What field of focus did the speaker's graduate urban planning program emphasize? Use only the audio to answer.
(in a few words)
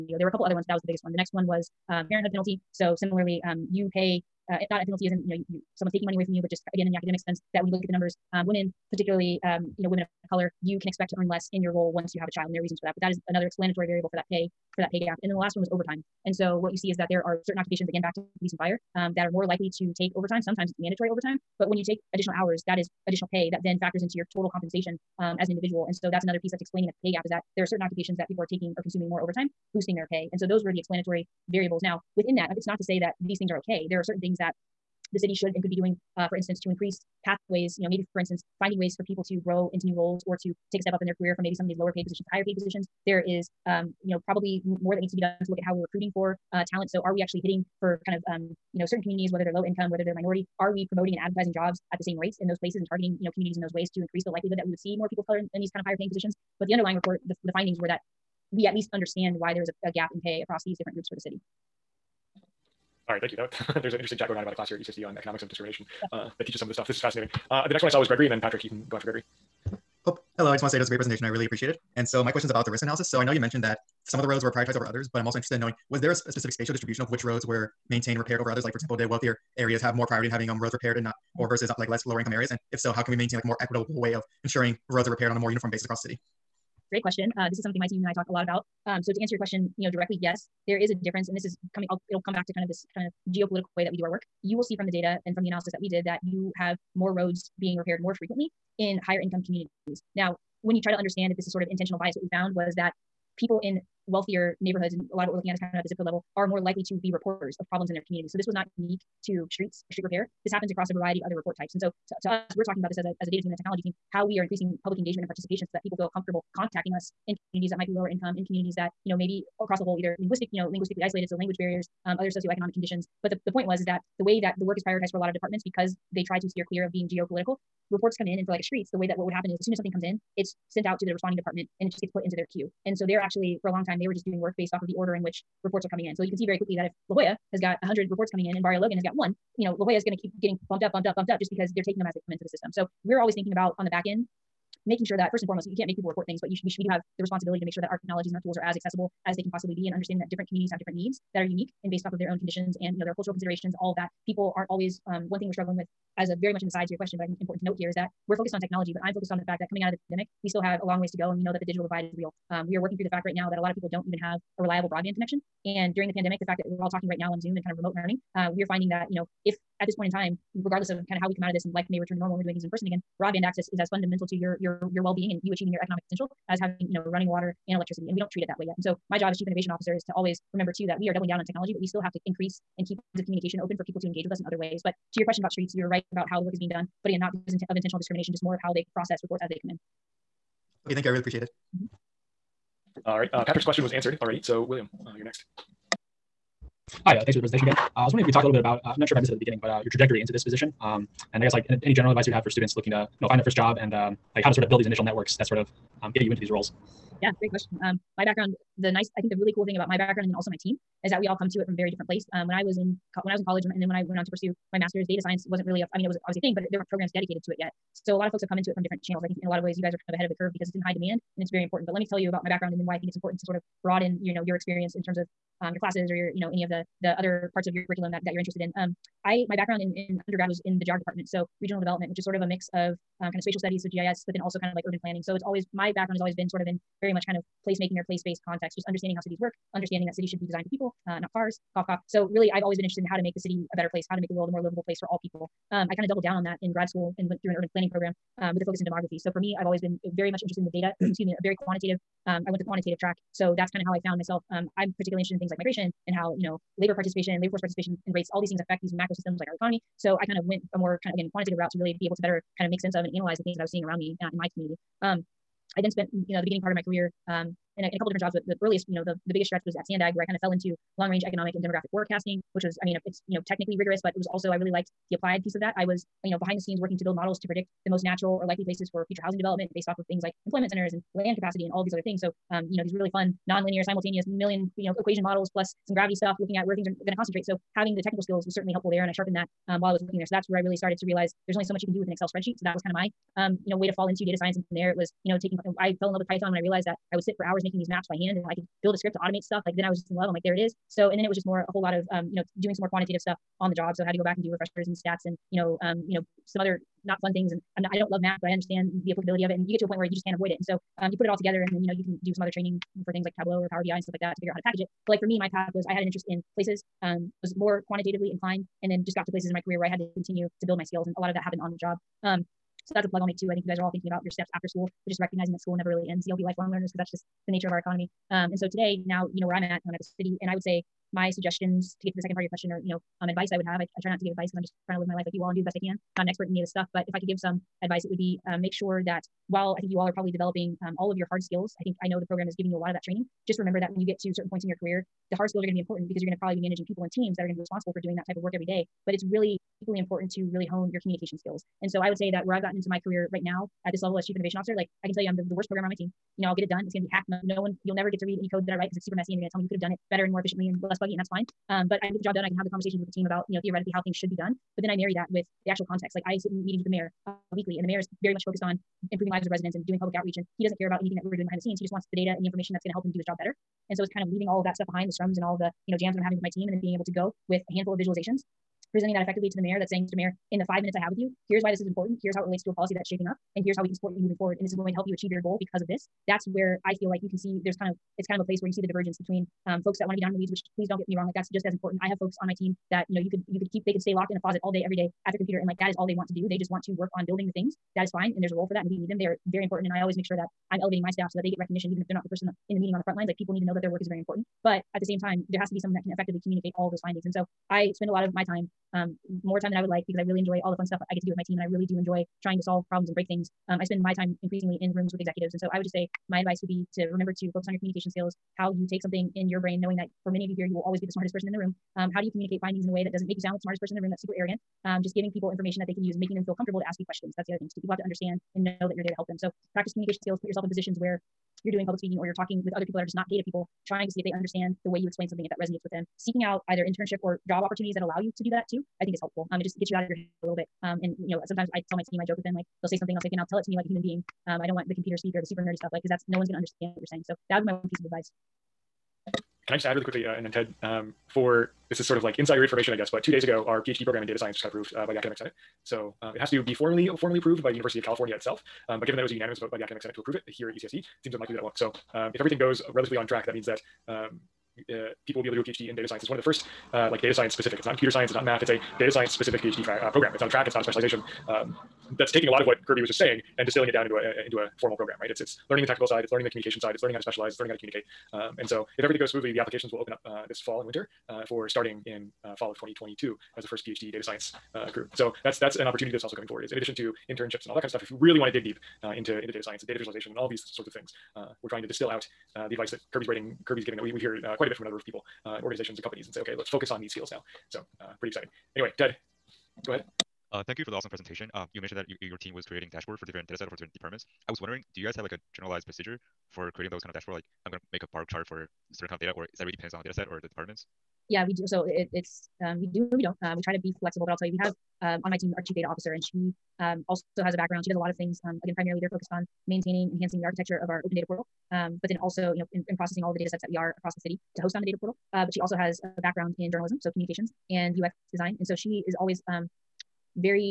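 Demography.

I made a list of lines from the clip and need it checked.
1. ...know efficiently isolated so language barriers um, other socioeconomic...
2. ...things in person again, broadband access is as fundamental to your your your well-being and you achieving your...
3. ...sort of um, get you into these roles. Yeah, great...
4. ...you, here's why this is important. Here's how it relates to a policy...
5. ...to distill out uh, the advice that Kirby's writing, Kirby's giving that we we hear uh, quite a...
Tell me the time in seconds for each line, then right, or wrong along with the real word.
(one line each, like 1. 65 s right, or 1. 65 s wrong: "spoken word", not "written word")
1. 120 s wrong: "linguistically", not "efficiently"
2. 172 s right
3. 205 s right
4. 381 s right
5. 491 s right.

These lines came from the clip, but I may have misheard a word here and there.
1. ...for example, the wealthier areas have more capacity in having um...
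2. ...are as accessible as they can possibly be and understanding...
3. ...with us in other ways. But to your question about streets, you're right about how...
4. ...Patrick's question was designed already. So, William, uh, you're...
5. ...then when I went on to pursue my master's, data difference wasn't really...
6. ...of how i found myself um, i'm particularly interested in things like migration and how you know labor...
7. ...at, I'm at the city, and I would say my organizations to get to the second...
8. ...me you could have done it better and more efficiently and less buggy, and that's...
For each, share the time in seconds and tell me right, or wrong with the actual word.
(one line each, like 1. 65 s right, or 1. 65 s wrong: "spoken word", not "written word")
1. 78 s wrong: "priority", not "capacity"
2. 148 s right
3. 184 s right
4. 193 s wrong: "answered", not "designed"
5. 213 s wrong: "science", not "difference"
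6. 253 s right
7. 329 s wrong: "suggestions", not "organizations"
8. 359 s right.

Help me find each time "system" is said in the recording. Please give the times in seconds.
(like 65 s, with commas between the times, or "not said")
142 s, 259 s.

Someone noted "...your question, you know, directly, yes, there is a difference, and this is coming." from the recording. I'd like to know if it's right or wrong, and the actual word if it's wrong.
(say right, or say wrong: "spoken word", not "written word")
right.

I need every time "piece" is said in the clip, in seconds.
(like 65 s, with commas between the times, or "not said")
26 s, 275 s, 447 s.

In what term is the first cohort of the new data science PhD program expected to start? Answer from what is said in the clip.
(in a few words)
Fall 2022.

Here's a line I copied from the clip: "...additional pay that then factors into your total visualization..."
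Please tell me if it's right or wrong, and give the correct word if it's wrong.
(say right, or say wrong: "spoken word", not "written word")
wrong: "compensation", not "visualization".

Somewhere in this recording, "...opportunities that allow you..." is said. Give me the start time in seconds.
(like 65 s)
437 s.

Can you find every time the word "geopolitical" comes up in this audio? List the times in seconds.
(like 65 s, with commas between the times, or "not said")
93 s, 127 s.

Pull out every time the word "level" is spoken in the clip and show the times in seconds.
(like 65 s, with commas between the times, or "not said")
106 s, 354 s.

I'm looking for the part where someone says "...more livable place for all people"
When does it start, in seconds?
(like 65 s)
244 s.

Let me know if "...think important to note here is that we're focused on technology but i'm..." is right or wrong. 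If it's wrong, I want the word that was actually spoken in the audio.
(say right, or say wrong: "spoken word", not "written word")
right.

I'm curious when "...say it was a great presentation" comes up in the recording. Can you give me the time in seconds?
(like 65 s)
70 s.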